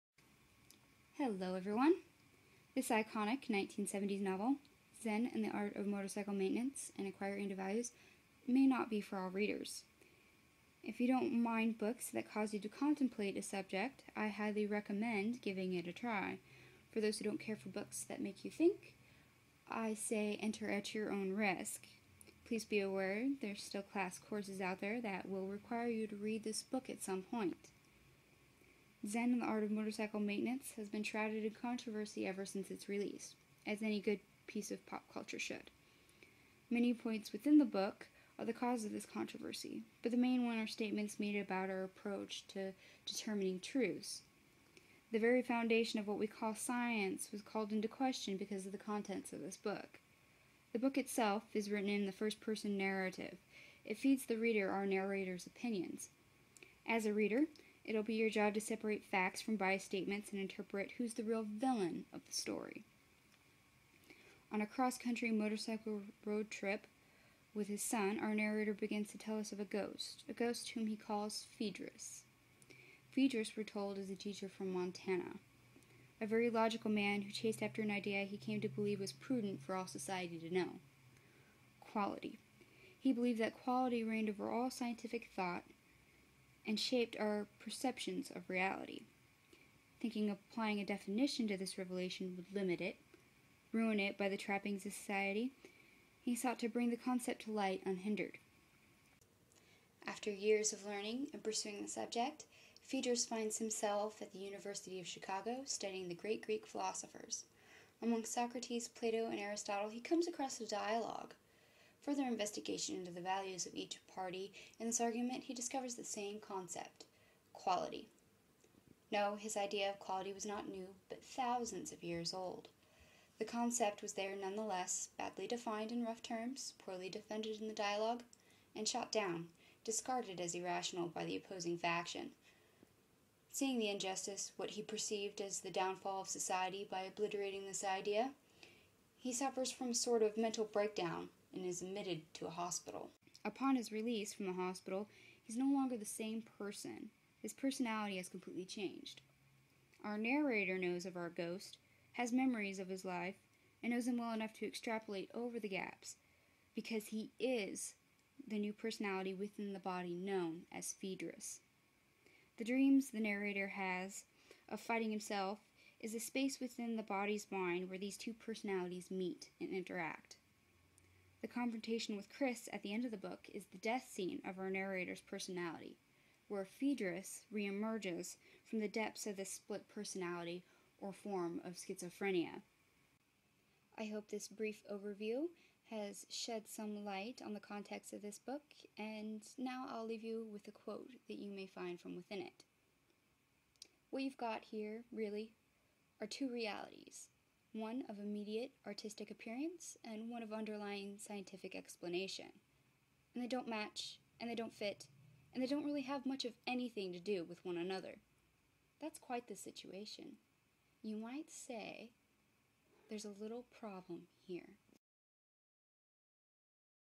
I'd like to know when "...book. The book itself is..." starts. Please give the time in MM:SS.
00:49.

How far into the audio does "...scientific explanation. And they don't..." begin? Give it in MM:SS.
03:21.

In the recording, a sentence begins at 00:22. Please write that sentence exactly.
Please be aware there's still class courses out there that will require you to read this book at some point.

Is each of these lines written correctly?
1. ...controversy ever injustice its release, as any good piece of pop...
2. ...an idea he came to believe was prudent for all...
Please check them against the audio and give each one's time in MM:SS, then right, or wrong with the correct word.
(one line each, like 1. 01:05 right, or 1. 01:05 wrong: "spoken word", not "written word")
1. 00:31 wrong: "since", not "injustice"
2. 01:17 right.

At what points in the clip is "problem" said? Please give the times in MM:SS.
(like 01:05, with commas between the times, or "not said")
03:33.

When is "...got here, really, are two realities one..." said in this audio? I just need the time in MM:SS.
03:14.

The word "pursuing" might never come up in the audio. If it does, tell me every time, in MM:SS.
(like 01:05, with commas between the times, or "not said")
01:41.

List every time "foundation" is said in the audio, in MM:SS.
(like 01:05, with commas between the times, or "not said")
00:45.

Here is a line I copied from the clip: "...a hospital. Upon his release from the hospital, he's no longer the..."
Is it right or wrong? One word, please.
right.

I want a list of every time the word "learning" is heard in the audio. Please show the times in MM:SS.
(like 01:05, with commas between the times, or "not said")
01:40.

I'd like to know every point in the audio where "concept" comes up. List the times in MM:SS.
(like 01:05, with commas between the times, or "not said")
01:36, 01:56, 02:03.